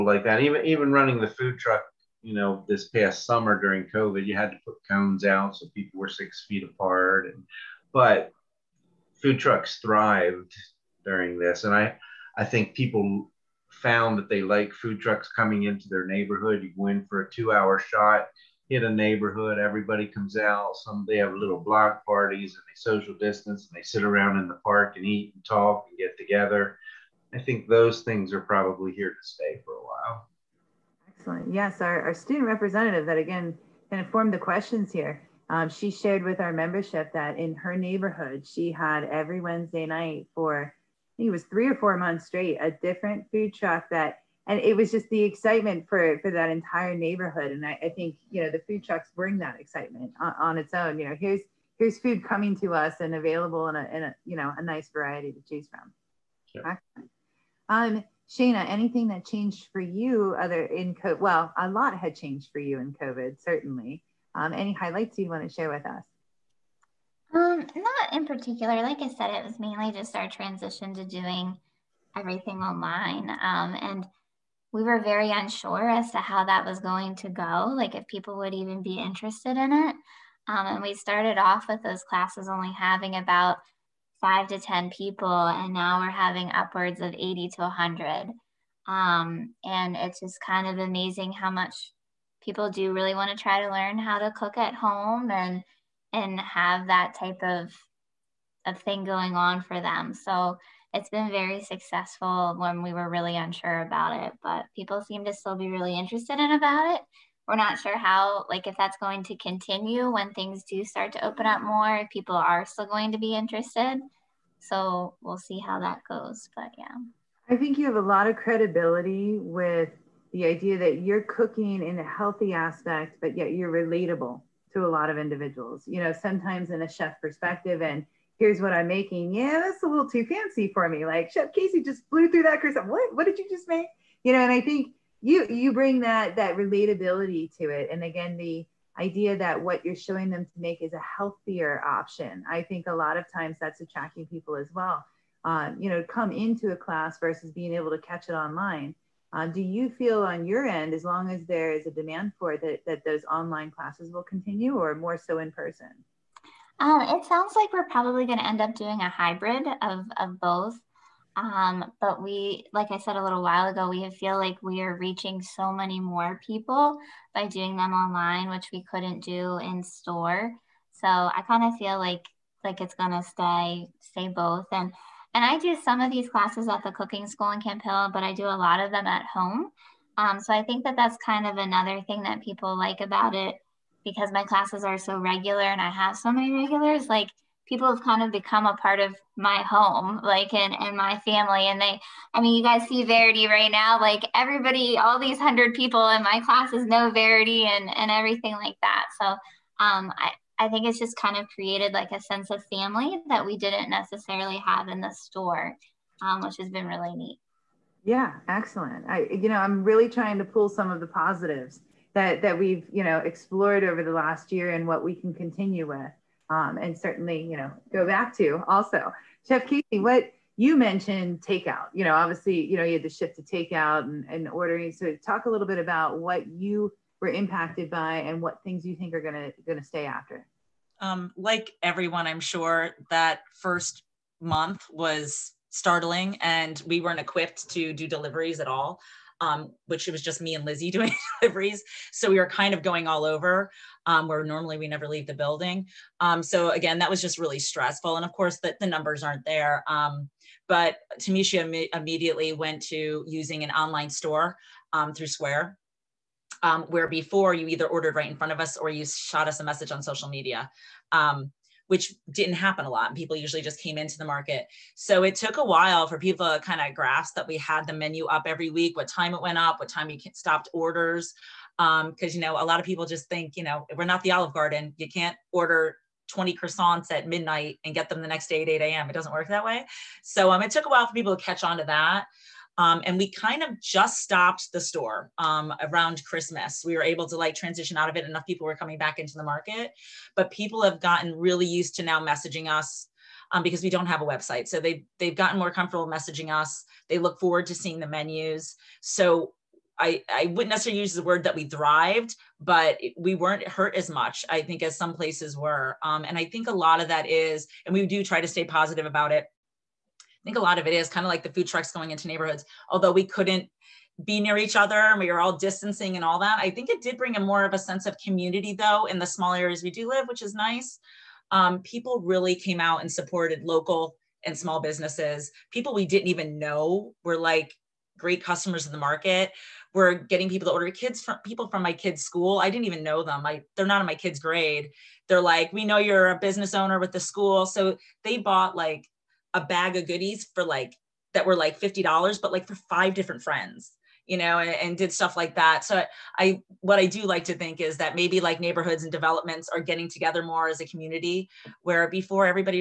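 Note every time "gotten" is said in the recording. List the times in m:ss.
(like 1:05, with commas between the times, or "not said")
4:50, 4:55.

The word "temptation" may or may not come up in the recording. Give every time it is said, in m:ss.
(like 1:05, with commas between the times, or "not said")
not said.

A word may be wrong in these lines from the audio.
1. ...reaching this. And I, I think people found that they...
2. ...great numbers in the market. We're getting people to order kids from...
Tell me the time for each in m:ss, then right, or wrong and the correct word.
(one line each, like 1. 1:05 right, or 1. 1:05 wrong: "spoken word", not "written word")
1. 0:11 wrong: "during", not "reaching"
2. 5:28 wrong: "customers", not "numbers".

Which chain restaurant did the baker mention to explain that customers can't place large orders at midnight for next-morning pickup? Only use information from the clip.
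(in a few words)
Olive Garden.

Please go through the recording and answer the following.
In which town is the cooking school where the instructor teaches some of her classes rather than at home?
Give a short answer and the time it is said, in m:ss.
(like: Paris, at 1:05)
Camp Hill, at 2:57.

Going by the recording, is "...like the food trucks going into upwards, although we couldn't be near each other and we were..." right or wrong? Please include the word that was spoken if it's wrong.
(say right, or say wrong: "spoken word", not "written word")
wrong: "neighborhoods", not "upwards".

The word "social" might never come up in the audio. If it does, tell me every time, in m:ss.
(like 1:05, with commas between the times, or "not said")
0:22, 4:20.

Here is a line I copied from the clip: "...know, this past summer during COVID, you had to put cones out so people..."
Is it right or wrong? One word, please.
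right.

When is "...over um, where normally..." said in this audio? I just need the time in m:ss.
4:03.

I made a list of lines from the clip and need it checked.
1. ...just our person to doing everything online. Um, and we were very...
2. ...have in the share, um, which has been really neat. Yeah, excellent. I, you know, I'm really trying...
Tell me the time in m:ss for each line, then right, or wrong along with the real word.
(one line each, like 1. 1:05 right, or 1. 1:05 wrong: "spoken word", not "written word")
1. 1:09 wrong: "transition", not "person"
2. 3:24 wrong: "store", not "share".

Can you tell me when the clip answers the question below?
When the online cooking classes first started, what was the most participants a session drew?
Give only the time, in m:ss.
1:24.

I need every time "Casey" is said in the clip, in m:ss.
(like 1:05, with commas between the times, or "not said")
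2:11, 3:39.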